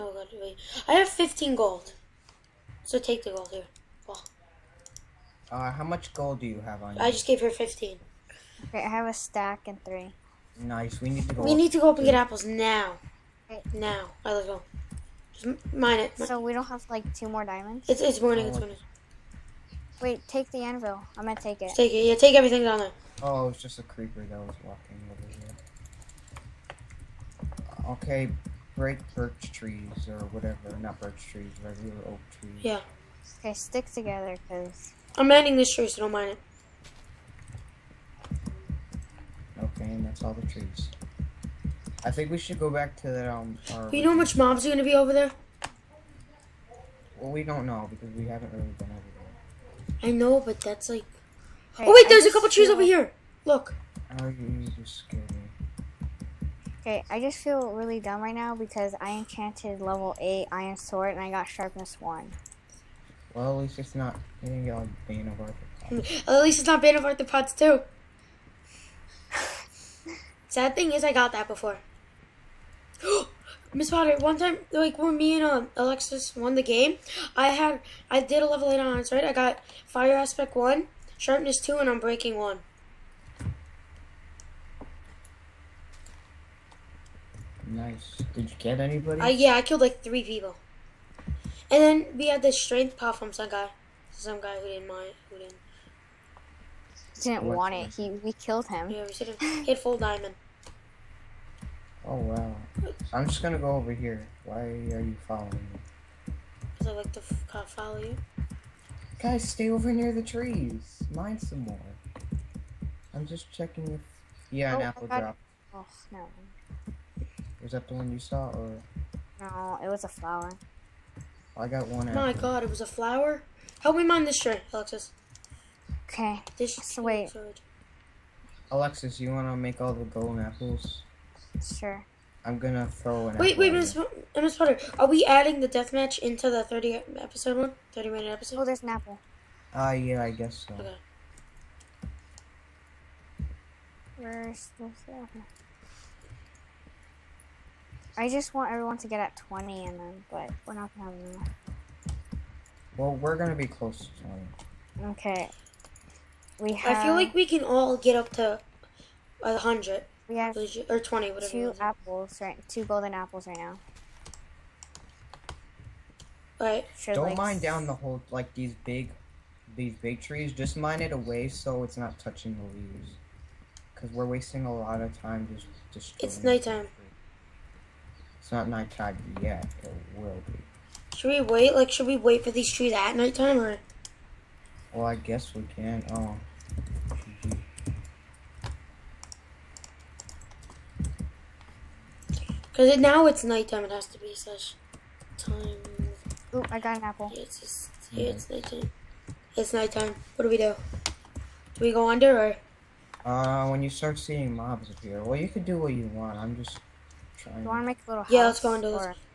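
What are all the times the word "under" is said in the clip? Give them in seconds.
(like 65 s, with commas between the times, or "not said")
202 s, 208 s.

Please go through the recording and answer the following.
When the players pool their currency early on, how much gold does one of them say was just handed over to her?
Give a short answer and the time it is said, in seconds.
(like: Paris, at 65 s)
15, at 7 s.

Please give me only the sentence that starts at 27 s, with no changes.
Okay, break birch trees or whatever.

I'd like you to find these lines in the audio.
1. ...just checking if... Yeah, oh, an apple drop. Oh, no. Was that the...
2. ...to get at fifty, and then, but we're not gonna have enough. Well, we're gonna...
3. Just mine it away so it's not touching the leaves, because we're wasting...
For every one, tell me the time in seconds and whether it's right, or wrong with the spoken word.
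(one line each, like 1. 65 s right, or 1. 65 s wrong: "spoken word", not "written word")
1. 113 s right
2. 148 s wrong: "twenty", not "fifty"
3. 170 s right.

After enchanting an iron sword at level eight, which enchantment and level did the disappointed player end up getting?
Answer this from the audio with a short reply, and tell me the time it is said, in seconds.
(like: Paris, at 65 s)
Sharpness 1, at 61 s.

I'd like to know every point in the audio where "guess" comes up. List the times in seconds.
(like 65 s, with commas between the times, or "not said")
140 s, 185 s.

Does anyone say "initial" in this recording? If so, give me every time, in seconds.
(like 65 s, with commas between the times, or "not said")
not said.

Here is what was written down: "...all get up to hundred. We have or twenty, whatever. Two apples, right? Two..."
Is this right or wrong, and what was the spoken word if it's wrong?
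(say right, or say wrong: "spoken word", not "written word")
right.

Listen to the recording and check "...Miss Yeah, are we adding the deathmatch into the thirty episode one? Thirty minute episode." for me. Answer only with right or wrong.
wrong.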